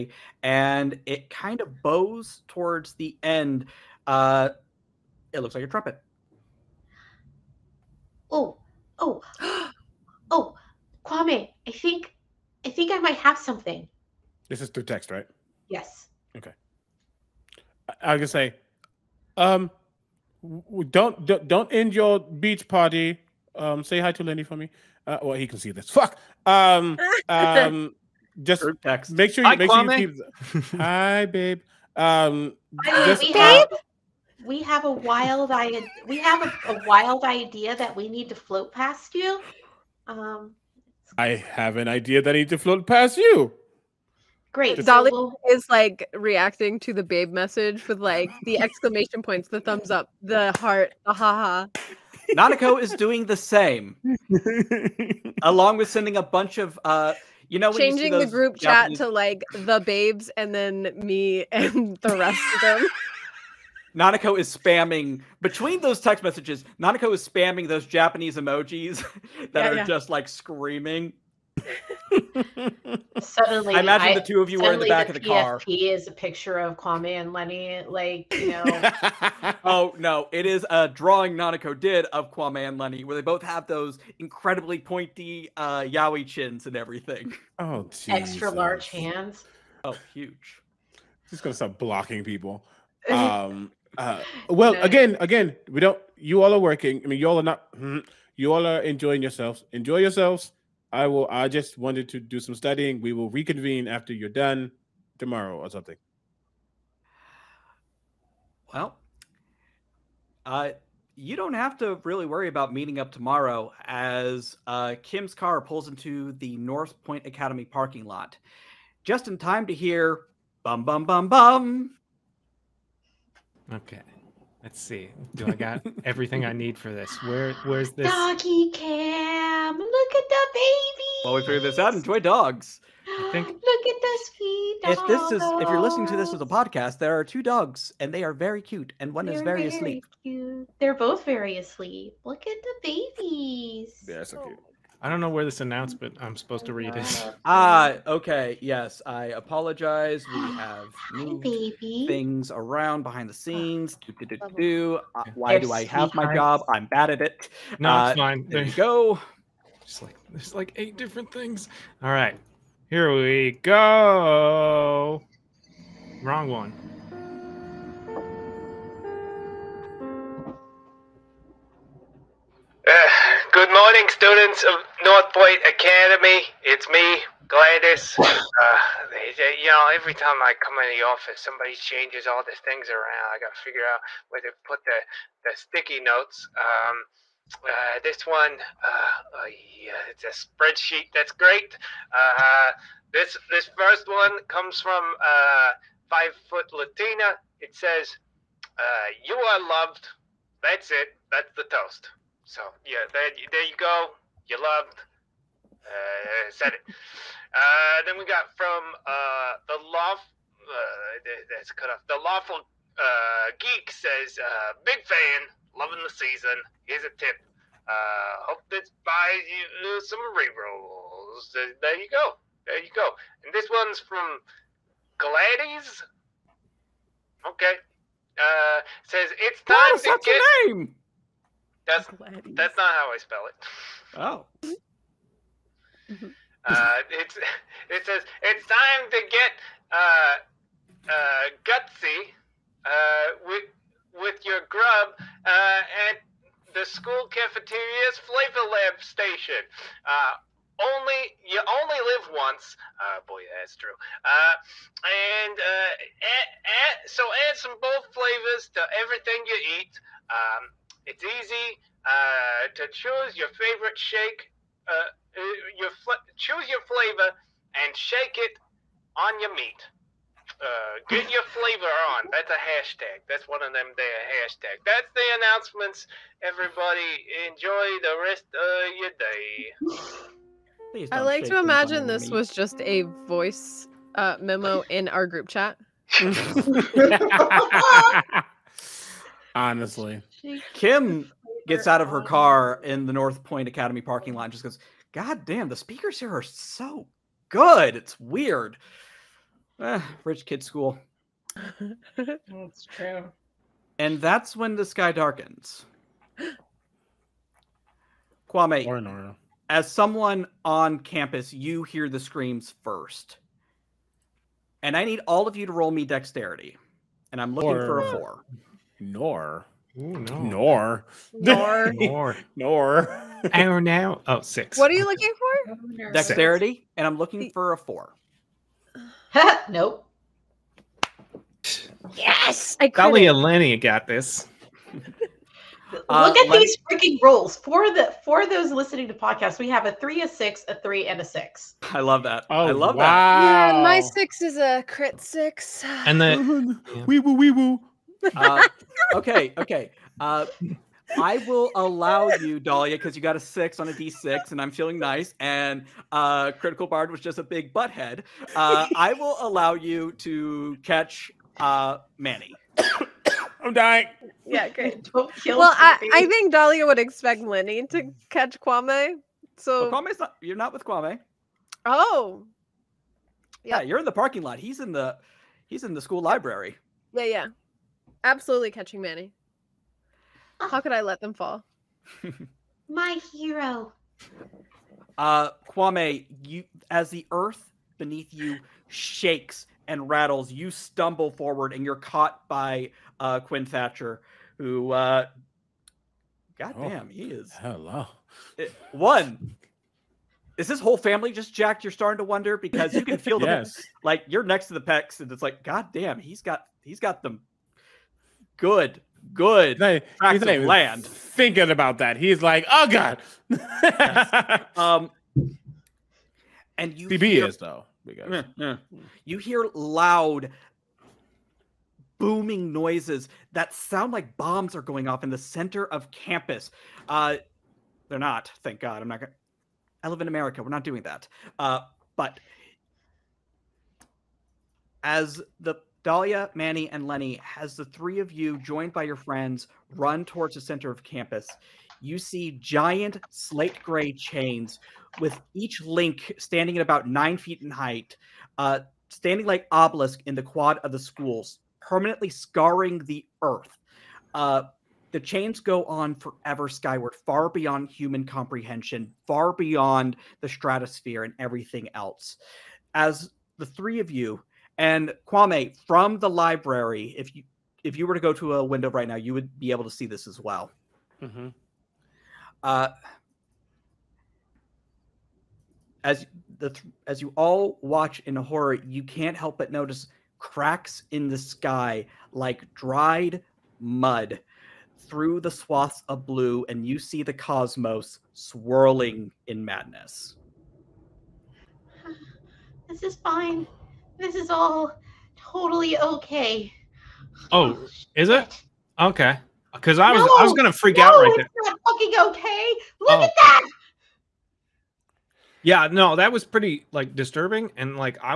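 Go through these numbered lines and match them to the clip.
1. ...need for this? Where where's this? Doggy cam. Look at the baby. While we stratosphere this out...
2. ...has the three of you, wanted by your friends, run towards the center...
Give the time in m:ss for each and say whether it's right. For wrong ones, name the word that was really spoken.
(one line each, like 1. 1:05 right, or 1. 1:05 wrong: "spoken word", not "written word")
1. 2:06 wrong: "figure", not "stratosphere"
2. 7:17 wrong: "joined", not "wanted".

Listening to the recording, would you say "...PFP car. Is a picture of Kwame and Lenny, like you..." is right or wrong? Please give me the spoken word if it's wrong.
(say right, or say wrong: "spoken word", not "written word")
right.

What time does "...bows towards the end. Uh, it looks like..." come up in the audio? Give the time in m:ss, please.
0:01.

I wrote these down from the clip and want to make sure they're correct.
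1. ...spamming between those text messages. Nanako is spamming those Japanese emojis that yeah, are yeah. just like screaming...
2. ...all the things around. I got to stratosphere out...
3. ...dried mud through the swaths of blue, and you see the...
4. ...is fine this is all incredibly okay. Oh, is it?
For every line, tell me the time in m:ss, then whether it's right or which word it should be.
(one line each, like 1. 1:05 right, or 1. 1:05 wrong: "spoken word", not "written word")
1. 1:04 right
2. 3:02 wrong: "figure", not "stratosphere"
3. 8:02 right
4. 8:13 wrong: "totally", not "incredibly".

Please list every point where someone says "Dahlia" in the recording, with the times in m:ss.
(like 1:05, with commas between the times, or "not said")
5:52, 6:06, 7:16.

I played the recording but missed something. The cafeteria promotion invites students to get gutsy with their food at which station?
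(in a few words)
flavor lab station.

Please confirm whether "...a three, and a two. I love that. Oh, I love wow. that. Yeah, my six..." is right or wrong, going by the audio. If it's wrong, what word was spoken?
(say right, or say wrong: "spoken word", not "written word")
wrong: "six", not "two".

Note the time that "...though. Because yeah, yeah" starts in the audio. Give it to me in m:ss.
6:57.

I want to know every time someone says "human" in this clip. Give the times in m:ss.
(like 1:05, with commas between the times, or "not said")
7:37.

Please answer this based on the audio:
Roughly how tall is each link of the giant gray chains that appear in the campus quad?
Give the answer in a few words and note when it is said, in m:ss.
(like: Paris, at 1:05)
9 feet, at 7:27.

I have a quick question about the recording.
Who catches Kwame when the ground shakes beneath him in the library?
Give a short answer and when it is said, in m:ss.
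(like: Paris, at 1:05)
Quinn Thatcher, at 6:33.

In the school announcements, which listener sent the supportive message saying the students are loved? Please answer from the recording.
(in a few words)
Five Foot Latina.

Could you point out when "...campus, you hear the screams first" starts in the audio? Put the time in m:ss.
5:10.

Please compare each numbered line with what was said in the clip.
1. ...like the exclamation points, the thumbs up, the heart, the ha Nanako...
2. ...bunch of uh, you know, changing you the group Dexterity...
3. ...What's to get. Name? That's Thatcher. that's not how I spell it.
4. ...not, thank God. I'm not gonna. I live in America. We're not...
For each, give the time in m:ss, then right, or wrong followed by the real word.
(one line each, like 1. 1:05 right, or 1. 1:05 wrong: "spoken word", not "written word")
1. 0:47 right
2. 0:56 wrong: "Japanese", not "Dexterity"
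3. 3:49 wrong: "Gladys", not "Thatcher"
4. 7:08 right.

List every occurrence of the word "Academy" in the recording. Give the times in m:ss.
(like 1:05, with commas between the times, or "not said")
1:57, 2:55, 4:53.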